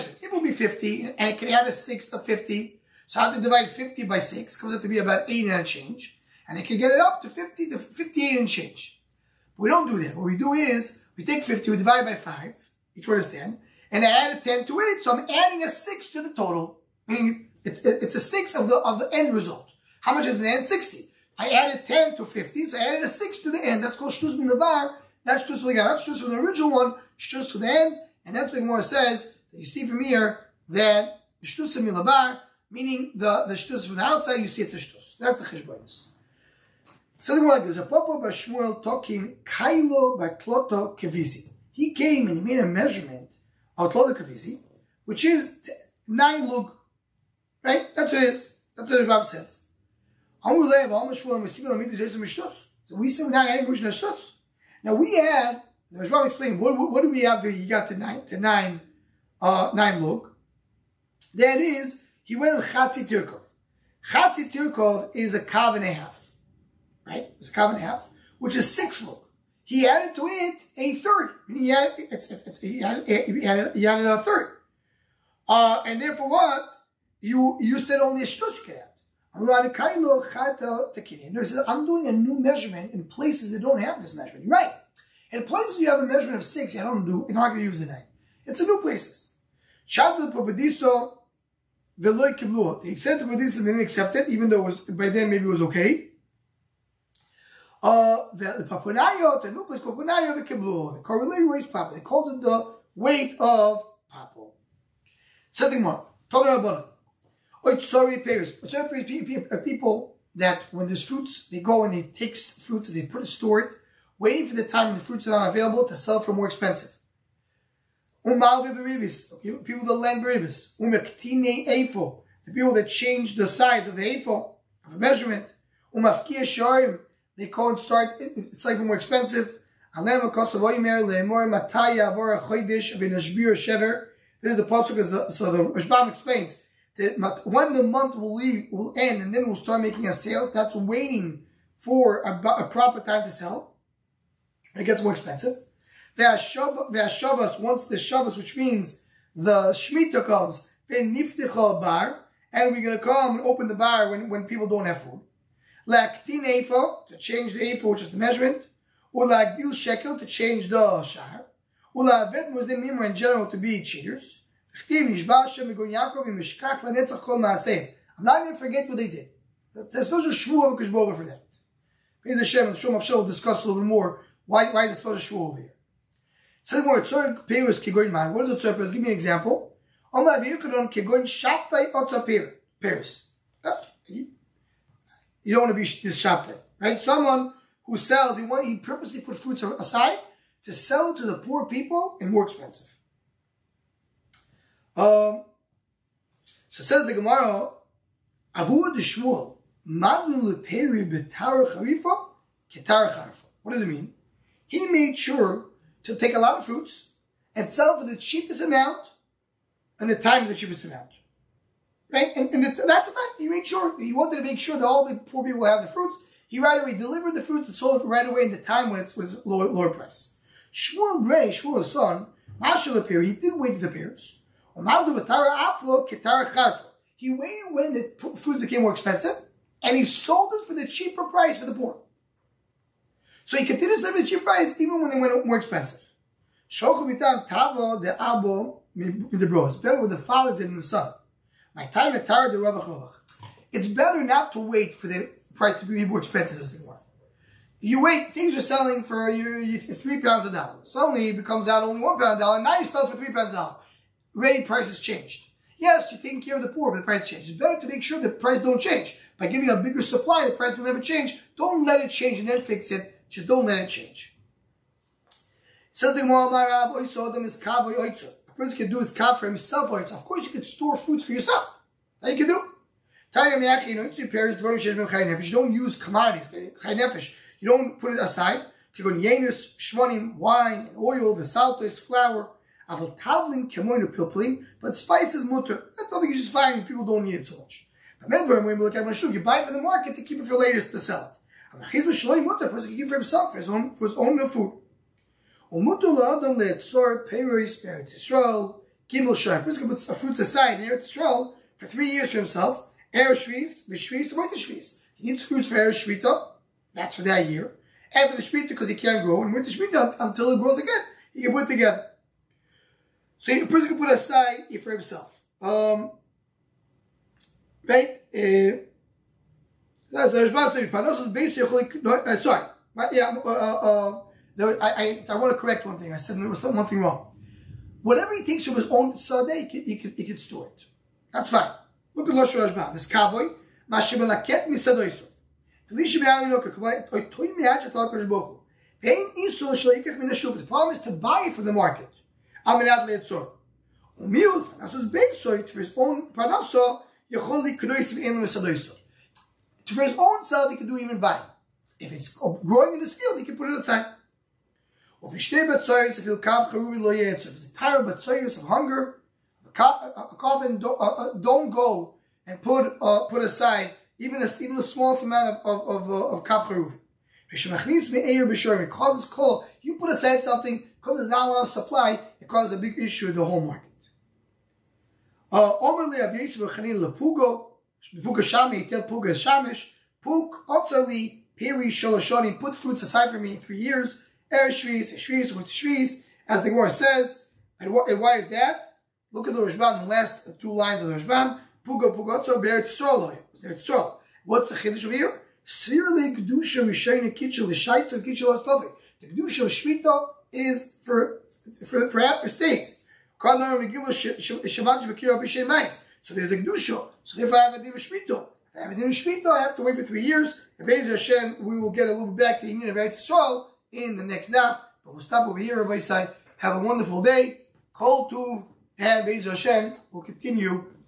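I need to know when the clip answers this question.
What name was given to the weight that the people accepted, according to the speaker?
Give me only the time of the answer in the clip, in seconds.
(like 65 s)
102 s.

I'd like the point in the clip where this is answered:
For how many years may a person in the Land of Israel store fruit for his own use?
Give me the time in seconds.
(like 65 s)
299 s.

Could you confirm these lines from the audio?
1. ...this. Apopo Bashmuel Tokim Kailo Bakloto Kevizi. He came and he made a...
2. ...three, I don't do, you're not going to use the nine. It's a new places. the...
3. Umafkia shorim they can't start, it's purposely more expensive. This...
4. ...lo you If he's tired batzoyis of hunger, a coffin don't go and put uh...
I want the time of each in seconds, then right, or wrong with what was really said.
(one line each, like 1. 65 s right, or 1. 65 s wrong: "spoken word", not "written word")
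1. 37 s right
2. 86 s wrong: "six", not "three"
3. 125 s wrong: "slightly", not "purposely"
4. 356 s right.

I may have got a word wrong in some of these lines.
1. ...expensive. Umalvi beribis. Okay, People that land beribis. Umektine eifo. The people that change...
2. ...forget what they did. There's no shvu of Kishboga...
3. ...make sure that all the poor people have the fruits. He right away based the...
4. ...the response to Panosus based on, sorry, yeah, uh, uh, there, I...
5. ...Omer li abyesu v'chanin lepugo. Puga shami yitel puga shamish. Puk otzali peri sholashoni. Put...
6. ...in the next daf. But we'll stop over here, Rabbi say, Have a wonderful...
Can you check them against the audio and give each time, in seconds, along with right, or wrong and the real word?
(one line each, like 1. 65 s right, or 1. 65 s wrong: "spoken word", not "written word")
1. 116 s right
2. 168 s right
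3. 214 s wrong: "delivered", not "based"
4. 320 s right
5. 375 s right
6. 413 s right.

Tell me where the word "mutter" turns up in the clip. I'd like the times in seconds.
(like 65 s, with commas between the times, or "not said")
285 s, 292 s.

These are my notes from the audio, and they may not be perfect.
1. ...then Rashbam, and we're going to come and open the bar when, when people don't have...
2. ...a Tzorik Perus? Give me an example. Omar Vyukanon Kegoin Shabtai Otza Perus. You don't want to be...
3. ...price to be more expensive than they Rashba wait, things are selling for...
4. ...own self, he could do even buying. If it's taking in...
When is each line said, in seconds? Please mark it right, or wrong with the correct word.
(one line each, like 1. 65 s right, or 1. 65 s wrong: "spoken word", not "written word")
1. 150 s wrong: "Bar", not "Rashbam"
2. 178 s right
3. 245 s wrong: "You", not "Rashba"
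4. 350 s wrong: "growing", not "taking".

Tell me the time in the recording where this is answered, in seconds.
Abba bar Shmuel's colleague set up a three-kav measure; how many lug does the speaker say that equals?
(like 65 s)
46 s.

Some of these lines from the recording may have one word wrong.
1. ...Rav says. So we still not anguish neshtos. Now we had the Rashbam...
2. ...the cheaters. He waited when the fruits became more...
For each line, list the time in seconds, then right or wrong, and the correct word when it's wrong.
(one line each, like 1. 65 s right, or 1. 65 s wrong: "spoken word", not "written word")
1. 49 s right
2. 223 s wrong: "pears", not "cheaters".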